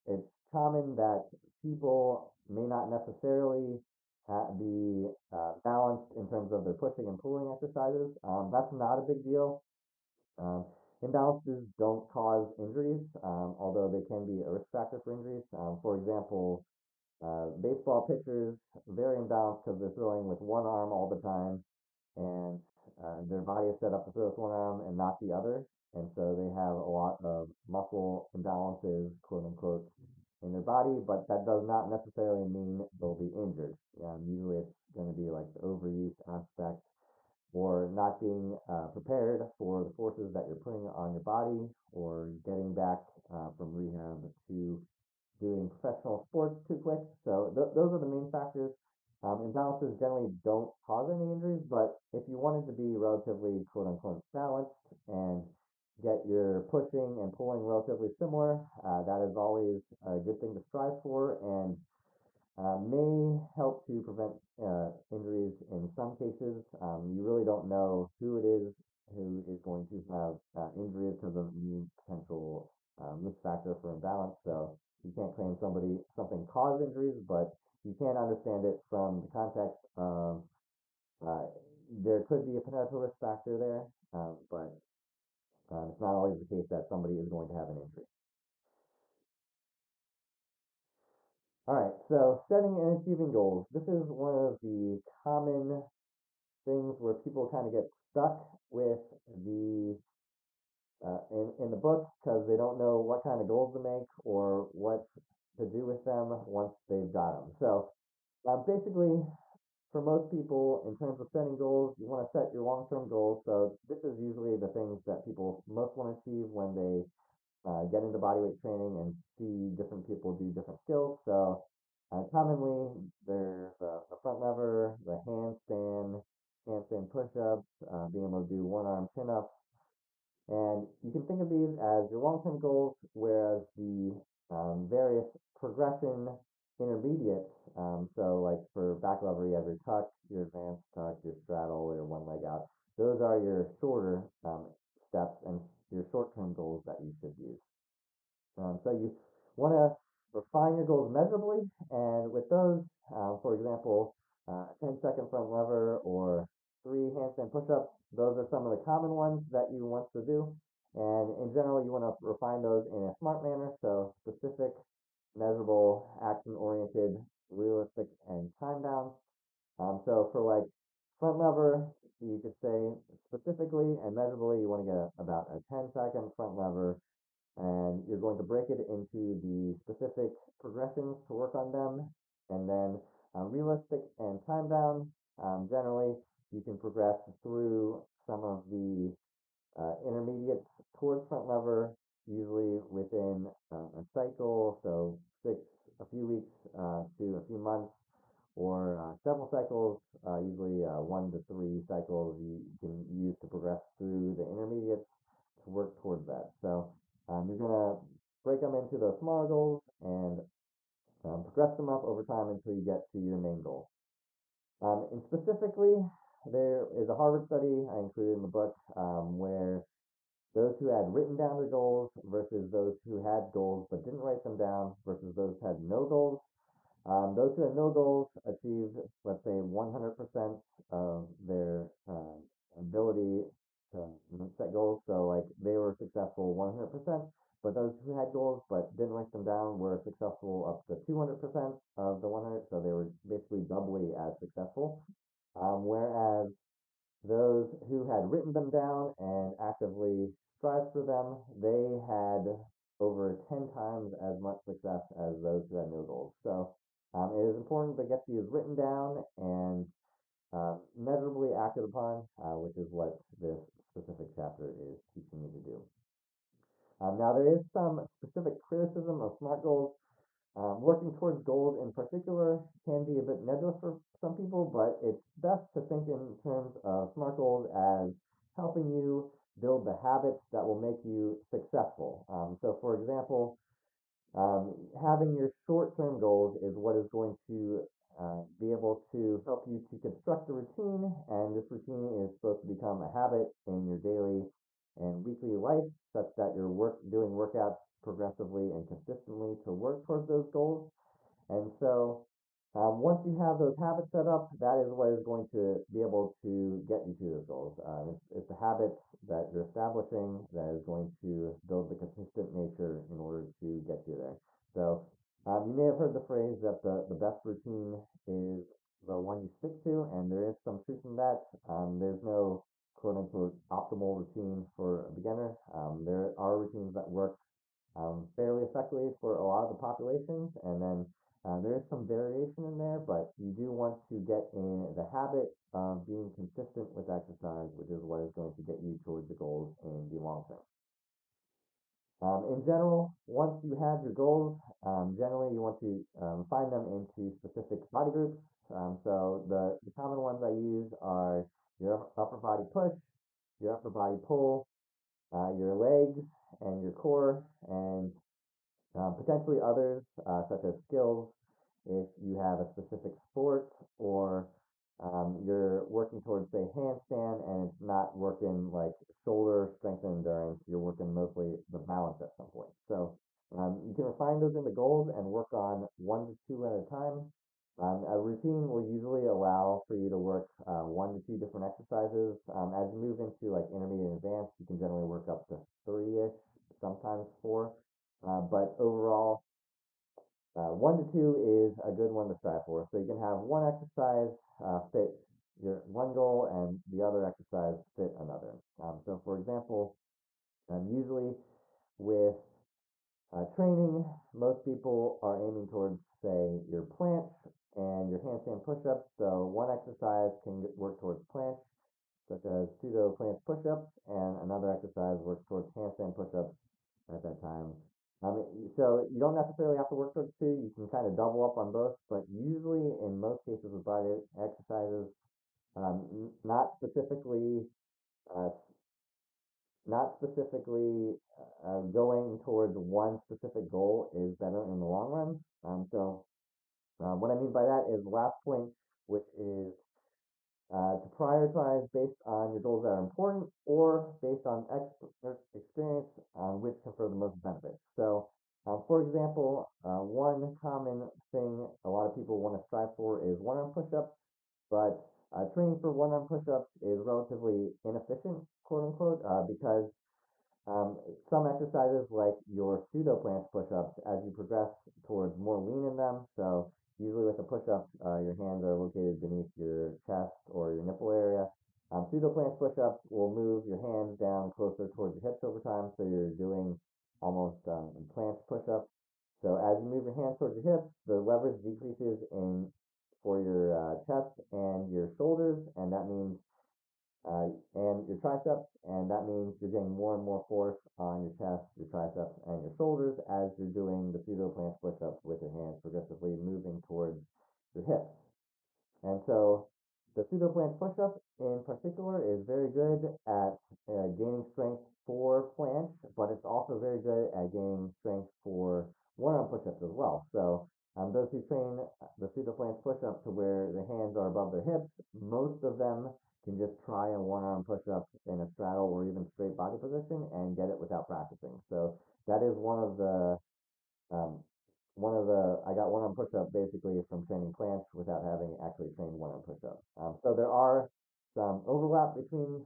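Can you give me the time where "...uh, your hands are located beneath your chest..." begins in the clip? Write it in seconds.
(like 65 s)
468 s.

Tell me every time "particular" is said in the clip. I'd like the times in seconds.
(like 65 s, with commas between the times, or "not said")
271 s, 501 s.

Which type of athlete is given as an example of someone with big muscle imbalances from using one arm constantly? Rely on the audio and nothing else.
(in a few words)
Baseball pitchers.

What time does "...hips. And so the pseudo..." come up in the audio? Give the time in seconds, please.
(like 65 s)
497 s.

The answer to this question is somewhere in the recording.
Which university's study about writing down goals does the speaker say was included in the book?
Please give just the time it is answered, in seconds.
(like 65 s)
217 s.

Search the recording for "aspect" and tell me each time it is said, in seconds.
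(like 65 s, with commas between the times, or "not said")
36 s.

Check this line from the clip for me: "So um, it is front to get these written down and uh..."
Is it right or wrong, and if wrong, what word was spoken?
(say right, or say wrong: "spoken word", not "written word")
wrong: "important", not "front".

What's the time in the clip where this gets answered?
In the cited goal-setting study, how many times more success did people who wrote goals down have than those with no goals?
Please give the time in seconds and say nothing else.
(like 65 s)
252 s.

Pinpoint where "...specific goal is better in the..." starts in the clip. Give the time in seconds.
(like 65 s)
433 s.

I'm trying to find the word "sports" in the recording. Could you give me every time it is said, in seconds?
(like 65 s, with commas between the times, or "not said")
46 s, 363 s.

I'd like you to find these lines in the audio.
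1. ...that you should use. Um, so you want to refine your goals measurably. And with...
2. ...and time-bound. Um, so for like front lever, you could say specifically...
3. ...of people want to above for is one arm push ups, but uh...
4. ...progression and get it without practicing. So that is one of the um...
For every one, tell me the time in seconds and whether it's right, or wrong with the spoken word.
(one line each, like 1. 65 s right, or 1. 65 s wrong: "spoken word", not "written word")
1. 146 s right
2. 168 s right
3. 452 s wrong: "strive", not "above"
4. 519 s wrong: "position", not "progression".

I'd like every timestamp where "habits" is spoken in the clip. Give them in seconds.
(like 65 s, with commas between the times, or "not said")
279 s, 293 s, 303 s, 308 s, 335 s.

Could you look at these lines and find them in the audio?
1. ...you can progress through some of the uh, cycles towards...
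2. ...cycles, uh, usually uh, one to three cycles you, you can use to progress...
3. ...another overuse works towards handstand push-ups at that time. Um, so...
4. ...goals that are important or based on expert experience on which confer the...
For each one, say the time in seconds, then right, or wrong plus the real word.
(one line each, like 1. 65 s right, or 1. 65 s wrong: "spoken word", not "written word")
1. 186 s wrong: "intermediates", not "cycles"
2. 199 s right
3. 414 s wrong: "exercise", not "overuse"
4. 442 s right.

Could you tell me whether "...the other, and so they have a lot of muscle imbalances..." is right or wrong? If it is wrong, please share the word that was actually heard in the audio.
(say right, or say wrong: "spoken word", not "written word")
right.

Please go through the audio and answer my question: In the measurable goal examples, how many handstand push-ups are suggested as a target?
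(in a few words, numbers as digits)
3.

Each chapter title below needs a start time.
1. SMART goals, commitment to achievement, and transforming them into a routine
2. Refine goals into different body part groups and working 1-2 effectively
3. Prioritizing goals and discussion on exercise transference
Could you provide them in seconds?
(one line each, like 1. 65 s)
1. 89 s
2. 341 s
3. 436 s.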